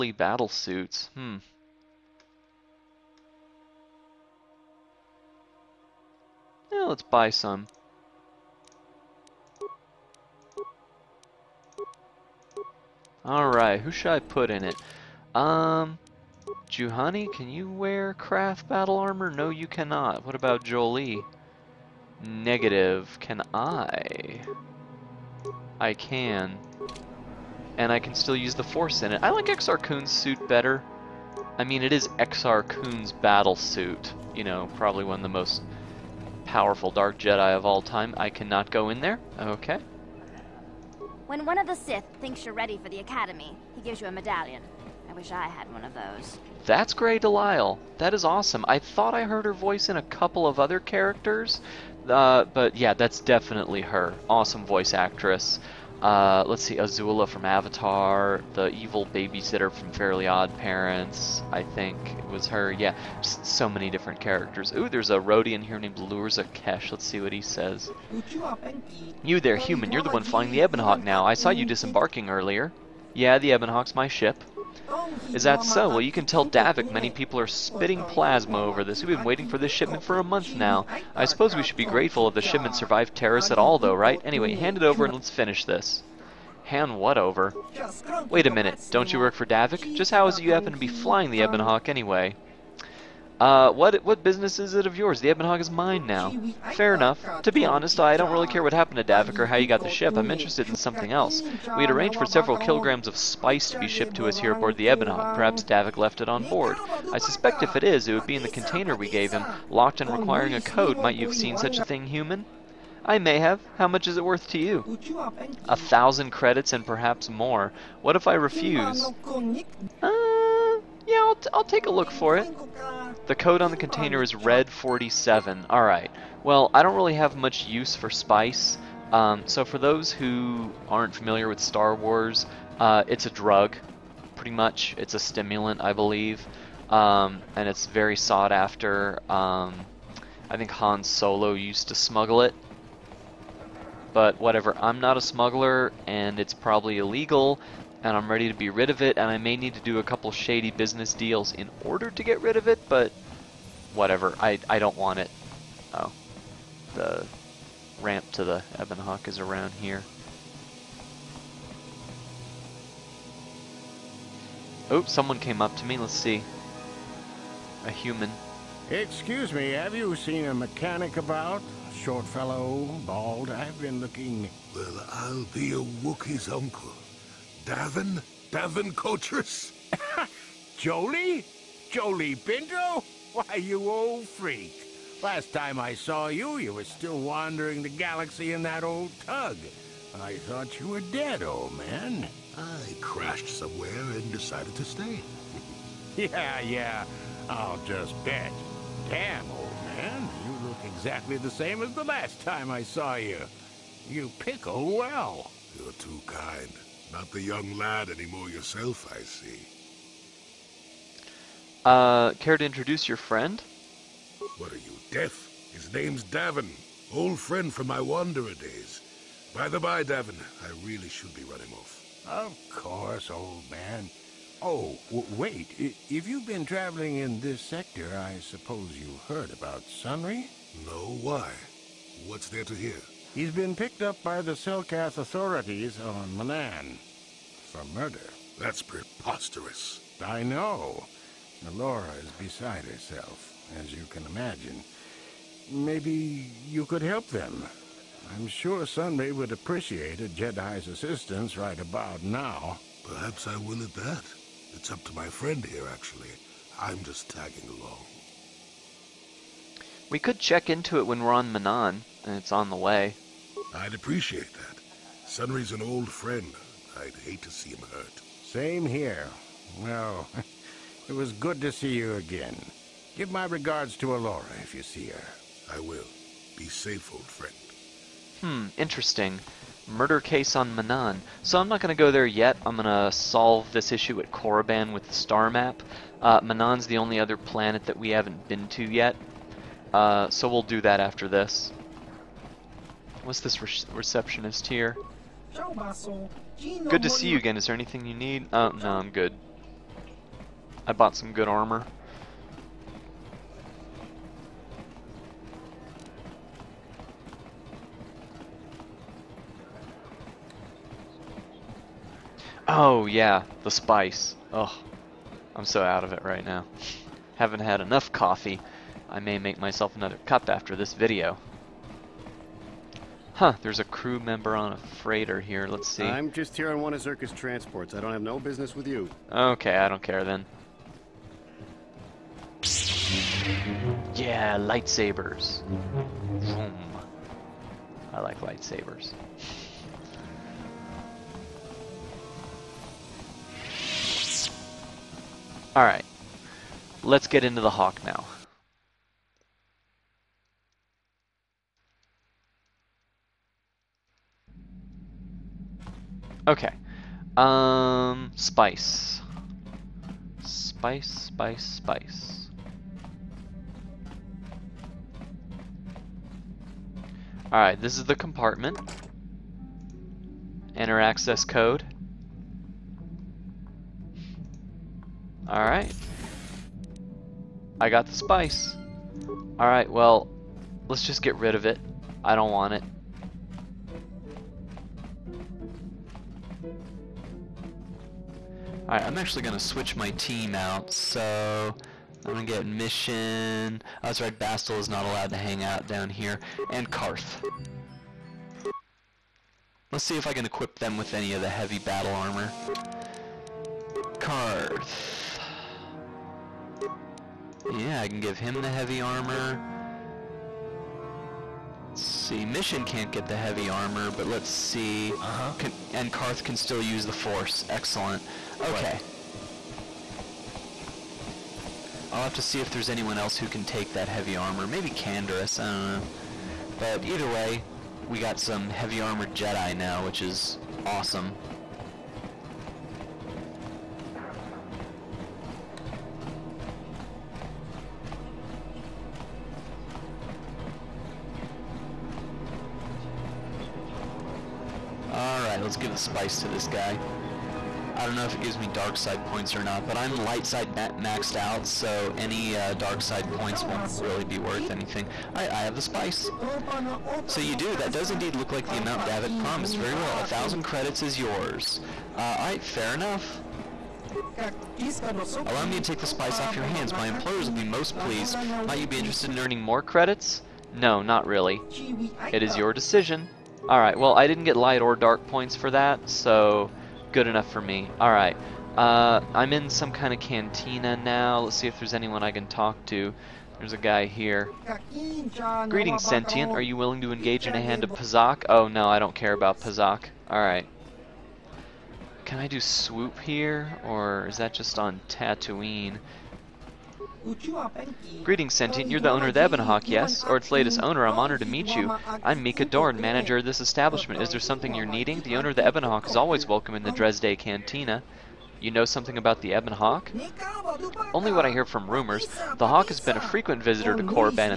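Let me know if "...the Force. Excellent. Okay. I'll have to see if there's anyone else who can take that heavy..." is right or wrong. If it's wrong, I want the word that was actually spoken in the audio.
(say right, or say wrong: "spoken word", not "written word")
right.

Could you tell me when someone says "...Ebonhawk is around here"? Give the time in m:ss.
2:38.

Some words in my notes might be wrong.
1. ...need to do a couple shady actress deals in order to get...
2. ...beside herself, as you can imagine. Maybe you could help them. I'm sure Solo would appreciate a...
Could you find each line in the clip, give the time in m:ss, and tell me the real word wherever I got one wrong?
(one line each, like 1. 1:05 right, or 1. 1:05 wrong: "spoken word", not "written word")
1. 2:29 wrong: "business", not "actress"
2. 4:02 wrong: "Sunry", not "Solo".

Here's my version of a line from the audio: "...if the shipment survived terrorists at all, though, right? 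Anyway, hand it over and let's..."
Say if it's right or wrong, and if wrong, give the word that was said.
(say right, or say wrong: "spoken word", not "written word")
right.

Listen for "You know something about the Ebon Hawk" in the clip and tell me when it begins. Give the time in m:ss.
8:28.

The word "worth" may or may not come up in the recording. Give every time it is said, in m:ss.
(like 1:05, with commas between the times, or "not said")
1:54, 7:34.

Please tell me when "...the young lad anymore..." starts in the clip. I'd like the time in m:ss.
3:27.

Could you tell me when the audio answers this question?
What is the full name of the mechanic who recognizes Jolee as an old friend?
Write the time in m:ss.
2:58.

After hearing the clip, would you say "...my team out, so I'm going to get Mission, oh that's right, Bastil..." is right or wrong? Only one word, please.
right.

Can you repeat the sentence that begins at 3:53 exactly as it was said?
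He's been picked up by the Selkath authorities on Manaan.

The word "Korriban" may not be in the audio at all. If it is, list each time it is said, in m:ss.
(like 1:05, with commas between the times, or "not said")
4:44, 8:34.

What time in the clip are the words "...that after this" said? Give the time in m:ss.
4:50.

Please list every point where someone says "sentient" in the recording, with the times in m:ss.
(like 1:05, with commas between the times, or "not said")
8:06, 8:18.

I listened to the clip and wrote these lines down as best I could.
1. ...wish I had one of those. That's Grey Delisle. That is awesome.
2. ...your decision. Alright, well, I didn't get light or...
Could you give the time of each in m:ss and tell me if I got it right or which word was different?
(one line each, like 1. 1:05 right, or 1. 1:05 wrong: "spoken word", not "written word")
1. 0:45 right
2. 7:52 right.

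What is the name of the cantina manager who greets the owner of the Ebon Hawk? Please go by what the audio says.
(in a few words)
Mika Dorn.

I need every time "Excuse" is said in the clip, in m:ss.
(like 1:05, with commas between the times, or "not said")
2:48.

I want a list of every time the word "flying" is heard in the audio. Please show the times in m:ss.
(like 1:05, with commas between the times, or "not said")
1:10, 1:30.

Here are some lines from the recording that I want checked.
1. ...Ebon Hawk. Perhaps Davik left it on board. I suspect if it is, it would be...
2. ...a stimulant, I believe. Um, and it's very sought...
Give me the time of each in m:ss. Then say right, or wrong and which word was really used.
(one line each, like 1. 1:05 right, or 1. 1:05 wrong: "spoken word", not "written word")
1. 1:44 right
2. 2:15 right.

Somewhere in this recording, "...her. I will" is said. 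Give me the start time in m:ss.
4:35.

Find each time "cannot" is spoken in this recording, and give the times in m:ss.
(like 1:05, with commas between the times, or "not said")
0:19, 0:38.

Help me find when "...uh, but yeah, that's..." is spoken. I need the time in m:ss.
0:52.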